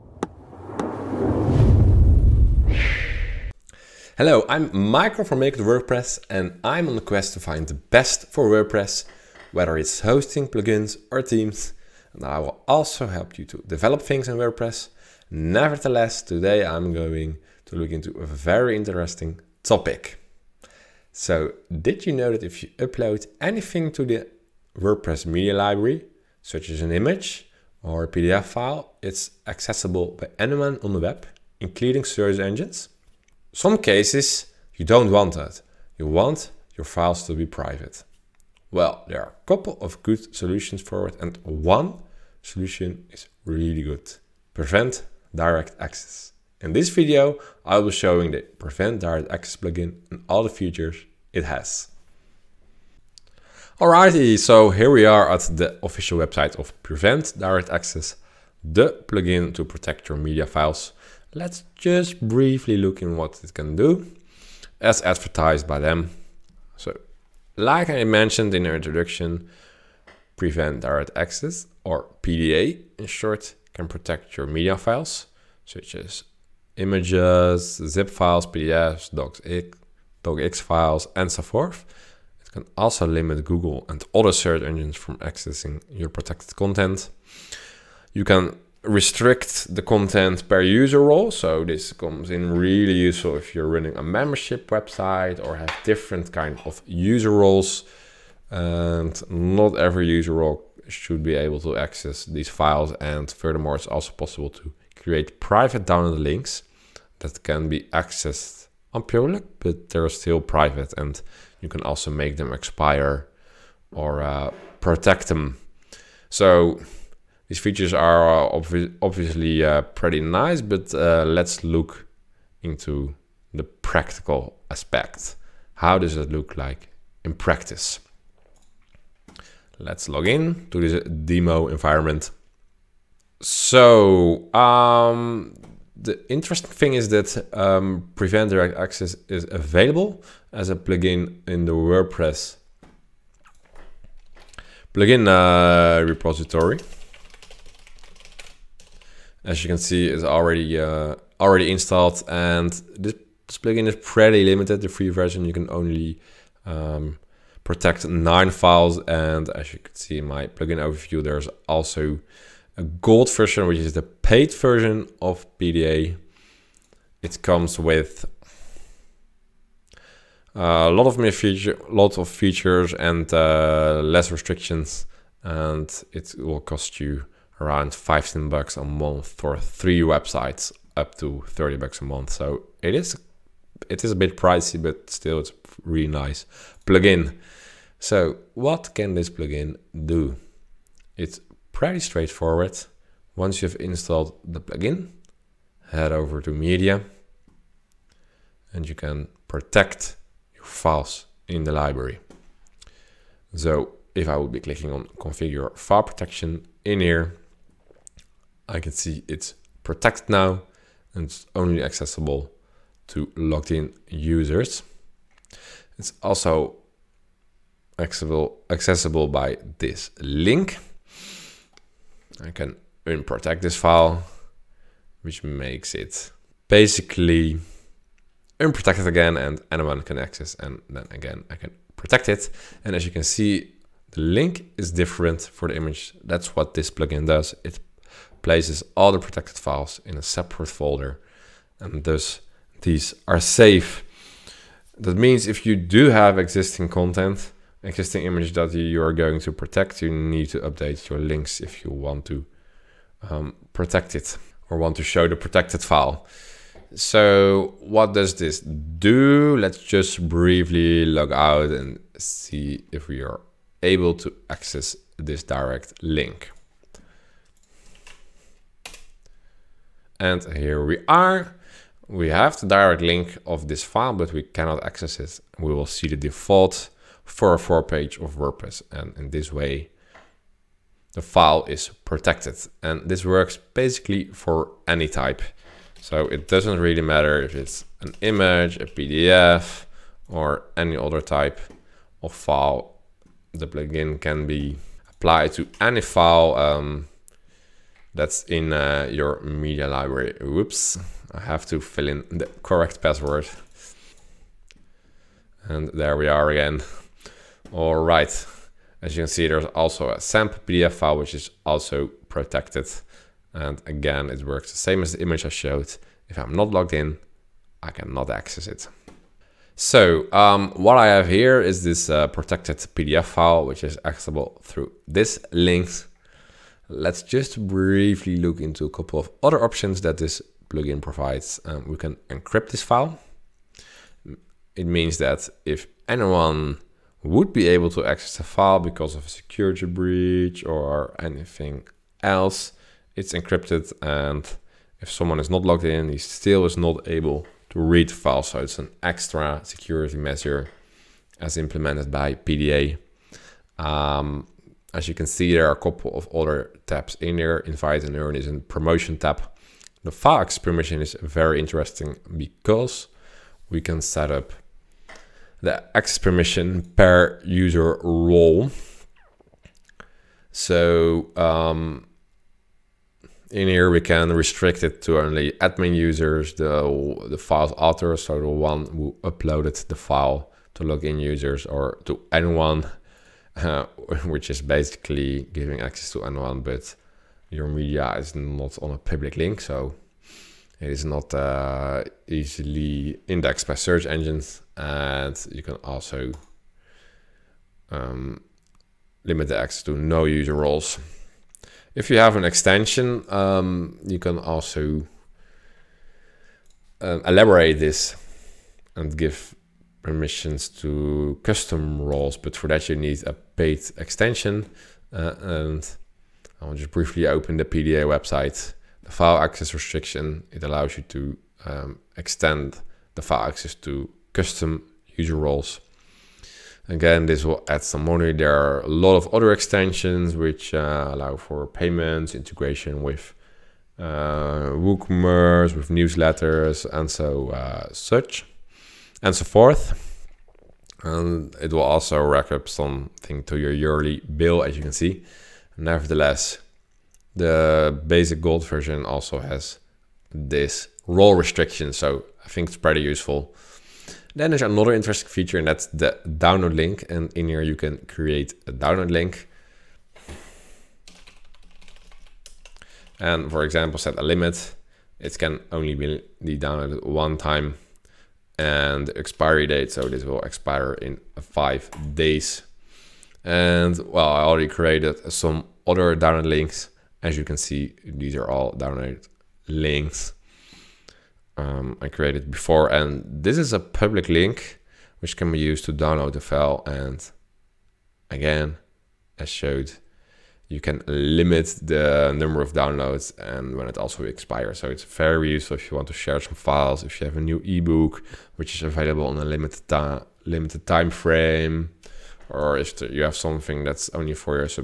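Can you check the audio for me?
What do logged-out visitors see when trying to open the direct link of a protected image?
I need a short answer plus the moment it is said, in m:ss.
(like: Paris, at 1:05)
default 404 page, at 4:36.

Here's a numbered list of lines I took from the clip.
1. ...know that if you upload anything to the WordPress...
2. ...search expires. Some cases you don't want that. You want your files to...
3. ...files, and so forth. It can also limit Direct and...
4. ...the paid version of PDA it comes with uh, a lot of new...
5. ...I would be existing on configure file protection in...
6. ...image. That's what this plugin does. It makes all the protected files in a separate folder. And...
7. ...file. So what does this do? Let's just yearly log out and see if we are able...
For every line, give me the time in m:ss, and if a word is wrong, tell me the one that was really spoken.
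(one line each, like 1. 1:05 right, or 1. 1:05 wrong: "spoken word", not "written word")
1. 0:22 right
2. 0:32 wrong: "engines", not "expires"
3. 1:20 wrong: "Google", not "Direct"
4. 2:43 right
5. 3:24 wrong: "clicking", not "existing"
6. 3:55 wrong: "places", not "makes"
7. 4:15 wrong: "briefly", not "yearly".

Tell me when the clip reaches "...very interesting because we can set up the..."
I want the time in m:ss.
6:01.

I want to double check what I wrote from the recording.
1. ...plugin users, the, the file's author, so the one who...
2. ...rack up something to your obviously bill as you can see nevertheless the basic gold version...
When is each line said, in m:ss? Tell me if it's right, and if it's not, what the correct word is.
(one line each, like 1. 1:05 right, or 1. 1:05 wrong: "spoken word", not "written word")
1. 6:15 wrong: "admin", not "plugin"
2. 7:22 wrong: "yearly", not "obviously".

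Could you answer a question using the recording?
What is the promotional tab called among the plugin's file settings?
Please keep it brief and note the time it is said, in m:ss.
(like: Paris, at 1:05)
Invite and earn, at 5:57.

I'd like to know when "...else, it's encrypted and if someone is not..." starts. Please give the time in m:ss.
5:42.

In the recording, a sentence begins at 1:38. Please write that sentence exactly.
And not every user role should be able to access these files.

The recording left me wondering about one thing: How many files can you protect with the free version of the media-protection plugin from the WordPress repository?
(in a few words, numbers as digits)
9.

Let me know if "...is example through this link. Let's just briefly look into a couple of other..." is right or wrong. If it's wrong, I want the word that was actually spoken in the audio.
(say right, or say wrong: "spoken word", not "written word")
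wrong: "accessible", not "example".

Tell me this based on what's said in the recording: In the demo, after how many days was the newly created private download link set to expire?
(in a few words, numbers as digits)
5.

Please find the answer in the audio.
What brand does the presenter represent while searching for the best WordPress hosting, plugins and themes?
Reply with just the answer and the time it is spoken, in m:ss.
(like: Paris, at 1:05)
Make It WorkPress, at 0:05.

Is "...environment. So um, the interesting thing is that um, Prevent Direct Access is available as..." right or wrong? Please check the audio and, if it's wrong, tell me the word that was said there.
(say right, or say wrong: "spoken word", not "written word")
right.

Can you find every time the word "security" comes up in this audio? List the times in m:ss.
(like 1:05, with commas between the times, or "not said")
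5:39, 5:49.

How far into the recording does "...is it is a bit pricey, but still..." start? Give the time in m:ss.
3:02.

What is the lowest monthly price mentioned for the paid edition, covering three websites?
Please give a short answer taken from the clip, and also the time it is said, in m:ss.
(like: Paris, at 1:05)
15 bucks, at 2:57.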